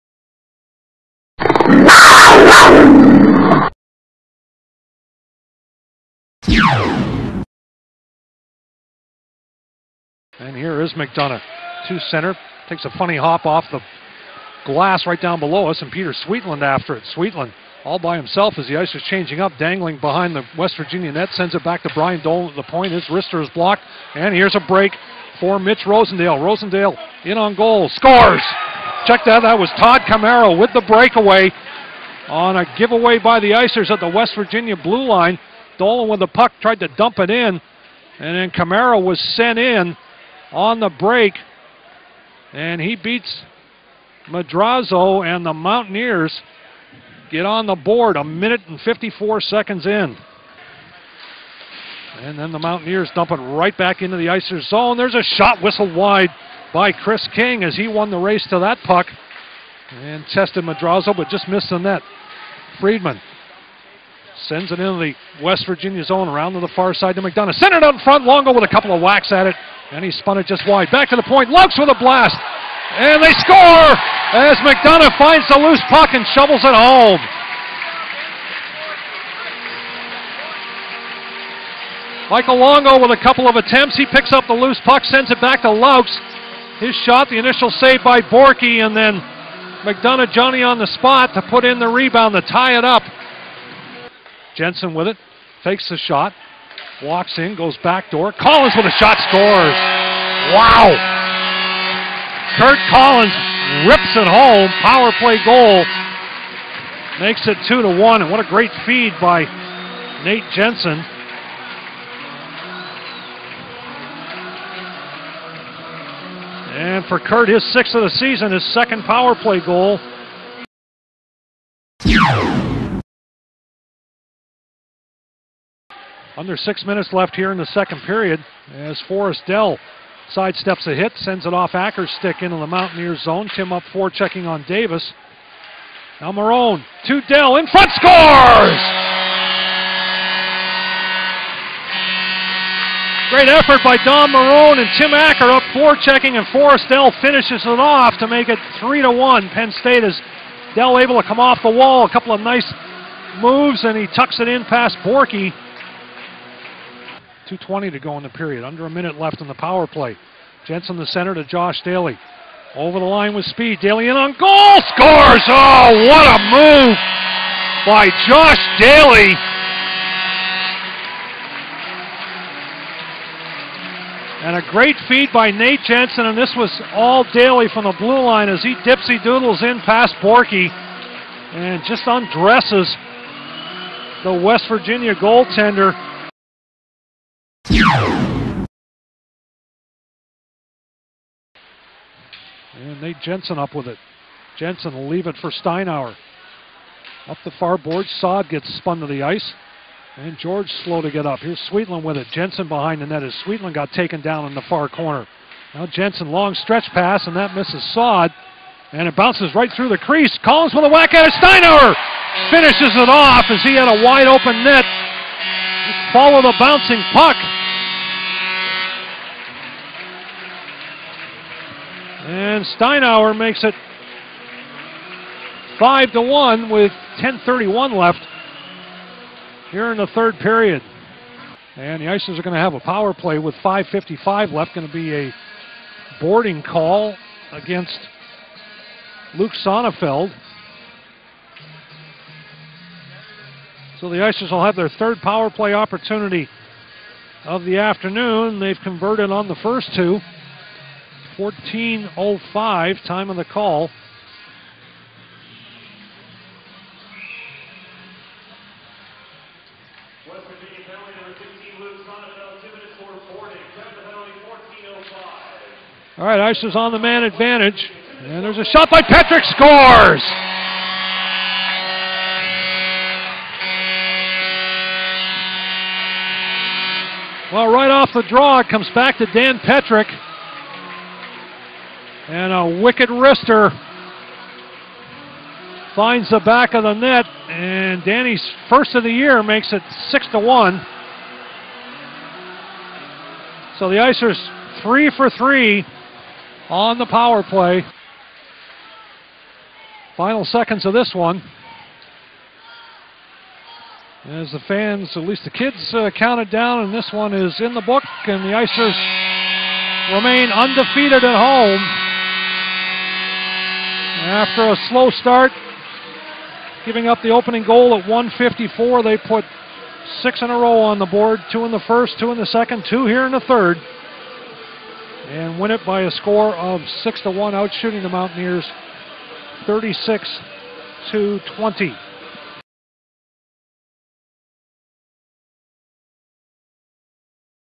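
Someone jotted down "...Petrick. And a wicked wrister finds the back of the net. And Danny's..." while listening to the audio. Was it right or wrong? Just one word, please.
right.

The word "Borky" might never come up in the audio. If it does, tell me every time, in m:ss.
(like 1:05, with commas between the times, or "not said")
1:28, 2:34, 3:00.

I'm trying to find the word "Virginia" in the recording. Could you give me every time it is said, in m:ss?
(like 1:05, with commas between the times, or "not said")
0:20, 0:34, 1:05, 3:04.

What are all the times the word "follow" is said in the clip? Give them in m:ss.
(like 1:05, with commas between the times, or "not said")
3:36.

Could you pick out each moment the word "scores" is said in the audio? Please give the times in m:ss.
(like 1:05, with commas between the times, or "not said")
0:27, 1:13, 1:39, 2:17, 2:44, 4:29, 5:26.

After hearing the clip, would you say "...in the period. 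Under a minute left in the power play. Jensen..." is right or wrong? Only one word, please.
right.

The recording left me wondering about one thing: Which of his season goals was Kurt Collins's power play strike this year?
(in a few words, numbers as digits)
6th.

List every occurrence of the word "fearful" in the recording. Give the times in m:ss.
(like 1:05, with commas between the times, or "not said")
not said.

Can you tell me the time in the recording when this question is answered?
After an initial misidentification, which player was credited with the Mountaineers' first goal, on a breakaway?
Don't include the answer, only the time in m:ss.
0:29.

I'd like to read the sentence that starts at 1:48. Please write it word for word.
And what a great feed by Nate Jensen.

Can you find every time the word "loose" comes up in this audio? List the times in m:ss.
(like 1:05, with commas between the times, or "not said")
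1:15, 1:24.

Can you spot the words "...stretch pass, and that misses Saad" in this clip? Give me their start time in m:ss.
3:26.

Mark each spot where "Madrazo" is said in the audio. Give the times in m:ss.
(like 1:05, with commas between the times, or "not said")
0:44, 1:00.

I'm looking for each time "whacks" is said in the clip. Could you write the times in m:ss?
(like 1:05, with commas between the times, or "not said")
1:08, 3:30.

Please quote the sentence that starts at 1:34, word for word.
Jensen with it, fakes the shot, walks in, goes back door.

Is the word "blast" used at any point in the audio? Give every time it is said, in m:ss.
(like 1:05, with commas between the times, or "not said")
1:12.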